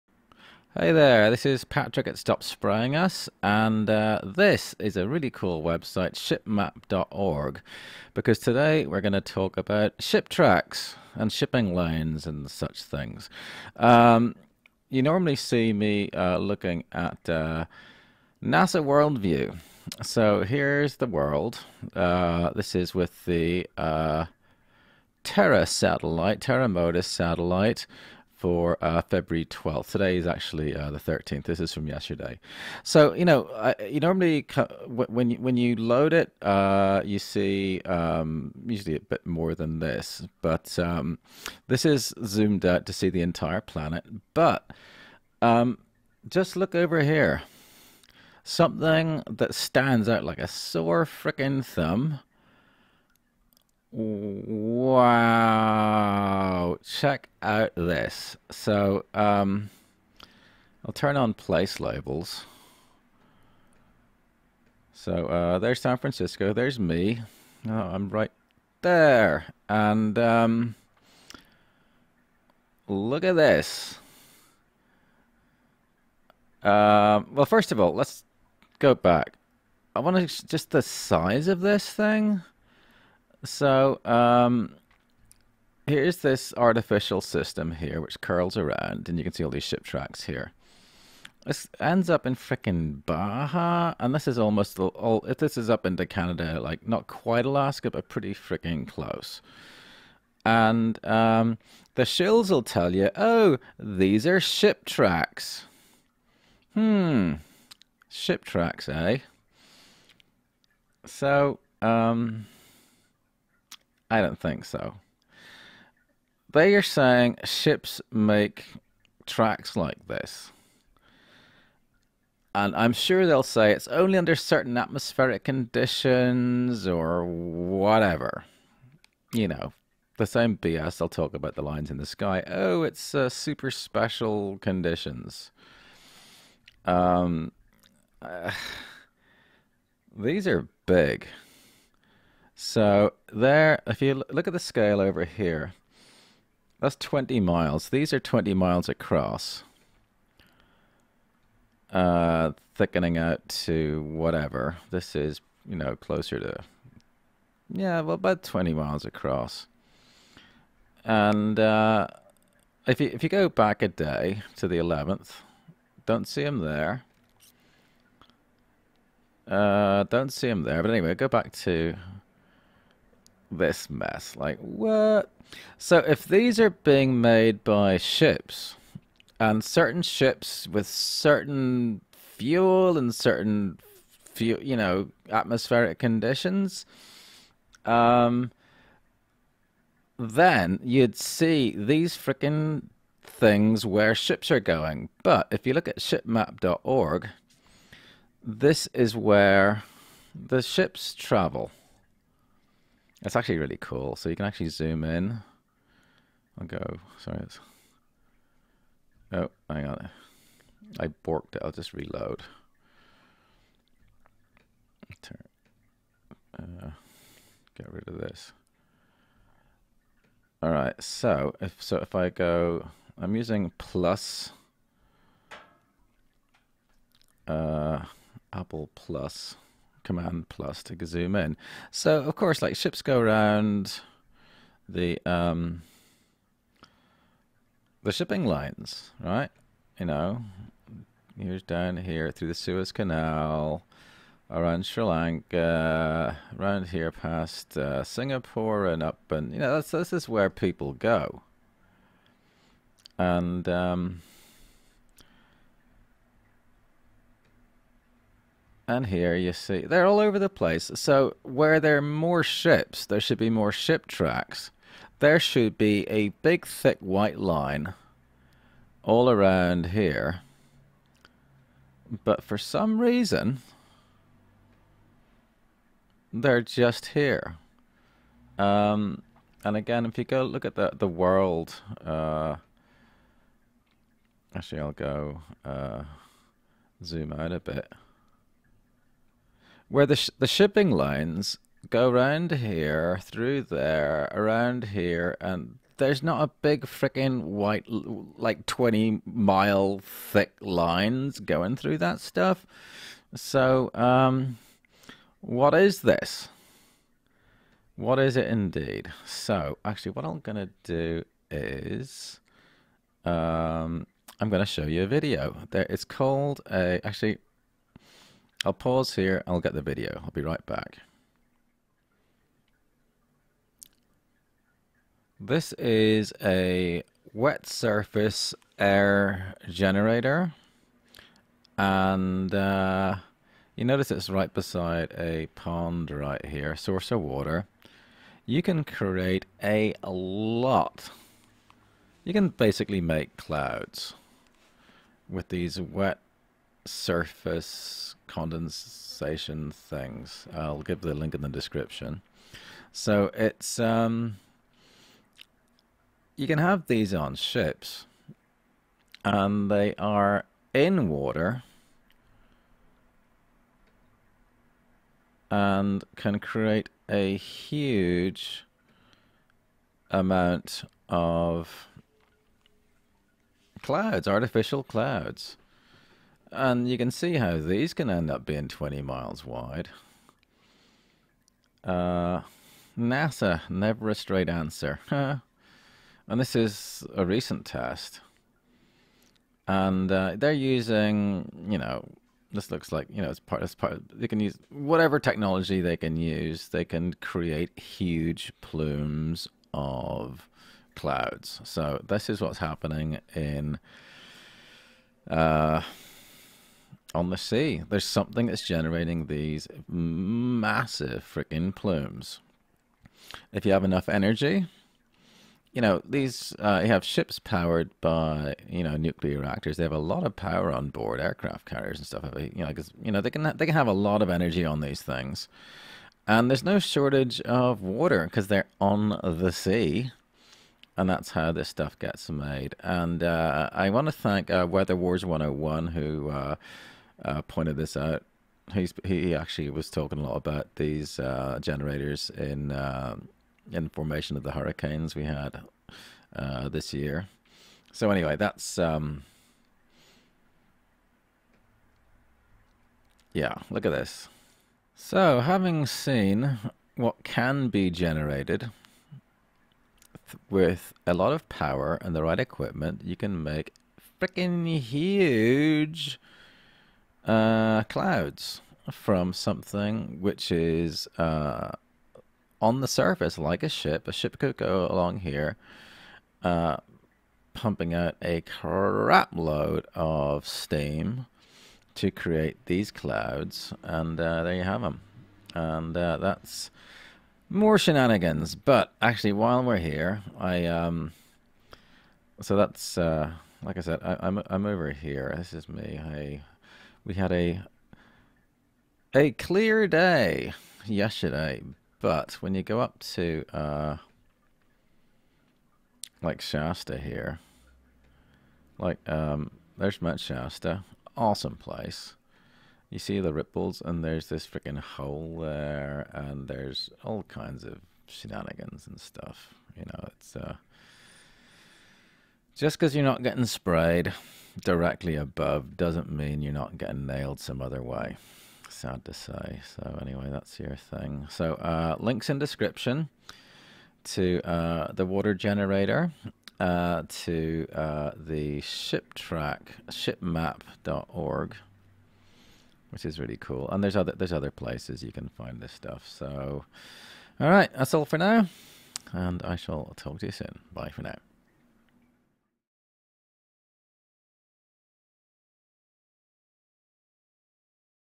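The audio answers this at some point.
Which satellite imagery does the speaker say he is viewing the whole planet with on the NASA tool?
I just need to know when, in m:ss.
0:26.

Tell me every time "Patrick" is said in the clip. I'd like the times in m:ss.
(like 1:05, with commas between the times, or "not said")
0:01.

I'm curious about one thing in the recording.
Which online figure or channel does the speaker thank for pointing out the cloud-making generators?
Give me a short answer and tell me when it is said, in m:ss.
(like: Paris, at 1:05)
Weather Wars 101, at 7:14.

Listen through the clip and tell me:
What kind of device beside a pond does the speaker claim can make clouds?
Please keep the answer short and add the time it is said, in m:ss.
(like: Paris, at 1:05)
wet surface air generator, at 5:27.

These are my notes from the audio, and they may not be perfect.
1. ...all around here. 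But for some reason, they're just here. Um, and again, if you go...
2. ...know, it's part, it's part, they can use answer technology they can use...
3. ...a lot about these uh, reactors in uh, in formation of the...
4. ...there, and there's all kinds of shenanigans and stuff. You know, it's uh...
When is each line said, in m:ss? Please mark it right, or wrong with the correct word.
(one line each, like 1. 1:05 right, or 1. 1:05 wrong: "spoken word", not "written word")
1. 4:29 right
2. 6:33 wrong: "whatever", not "answer"
3. 7:20 wrong: "generators", not "reactors"
4. 8:35 right.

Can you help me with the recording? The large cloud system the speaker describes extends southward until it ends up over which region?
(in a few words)
Baja.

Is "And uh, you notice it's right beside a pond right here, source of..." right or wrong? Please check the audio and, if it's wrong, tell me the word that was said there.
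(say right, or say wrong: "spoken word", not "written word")
right.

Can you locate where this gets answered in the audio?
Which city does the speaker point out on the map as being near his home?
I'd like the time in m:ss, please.
1:05.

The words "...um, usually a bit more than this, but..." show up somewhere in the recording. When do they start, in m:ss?
0:37.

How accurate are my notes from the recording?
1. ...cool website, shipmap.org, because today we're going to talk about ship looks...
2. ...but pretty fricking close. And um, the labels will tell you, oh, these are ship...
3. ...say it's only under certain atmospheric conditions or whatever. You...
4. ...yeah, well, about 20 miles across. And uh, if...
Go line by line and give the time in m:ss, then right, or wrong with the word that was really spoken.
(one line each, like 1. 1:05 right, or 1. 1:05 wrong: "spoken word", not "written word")
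1. 0:05 wrong: "tracks", not "looks"
2. 1:37 wrong: "shills", not "labels"
3. 2:03 right
4. 2:37 right.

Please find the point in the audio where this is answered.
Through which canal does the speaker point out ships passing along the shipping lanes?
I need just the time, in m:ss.
4:02.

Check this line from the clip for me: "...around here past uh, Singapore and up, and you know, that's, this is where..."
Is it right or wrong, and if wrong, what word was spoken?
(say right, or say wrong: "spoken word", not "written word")
right.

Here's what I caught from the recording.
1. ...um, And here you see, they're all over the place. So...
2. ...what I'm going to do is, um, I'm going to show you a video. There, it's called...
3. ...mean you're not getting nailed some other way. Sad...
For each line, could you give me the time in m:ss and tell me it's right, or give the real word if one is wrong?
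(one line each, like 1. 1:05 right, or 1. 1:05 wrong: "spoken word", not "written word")
1. 4:13 right
2. 5:10 right
3. 8:46 right.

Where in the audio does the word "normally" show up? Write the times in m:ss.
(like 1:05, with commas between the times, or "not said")
0:15, 0:33.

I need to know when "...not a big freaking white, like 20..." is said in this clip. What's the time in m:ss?
4:56.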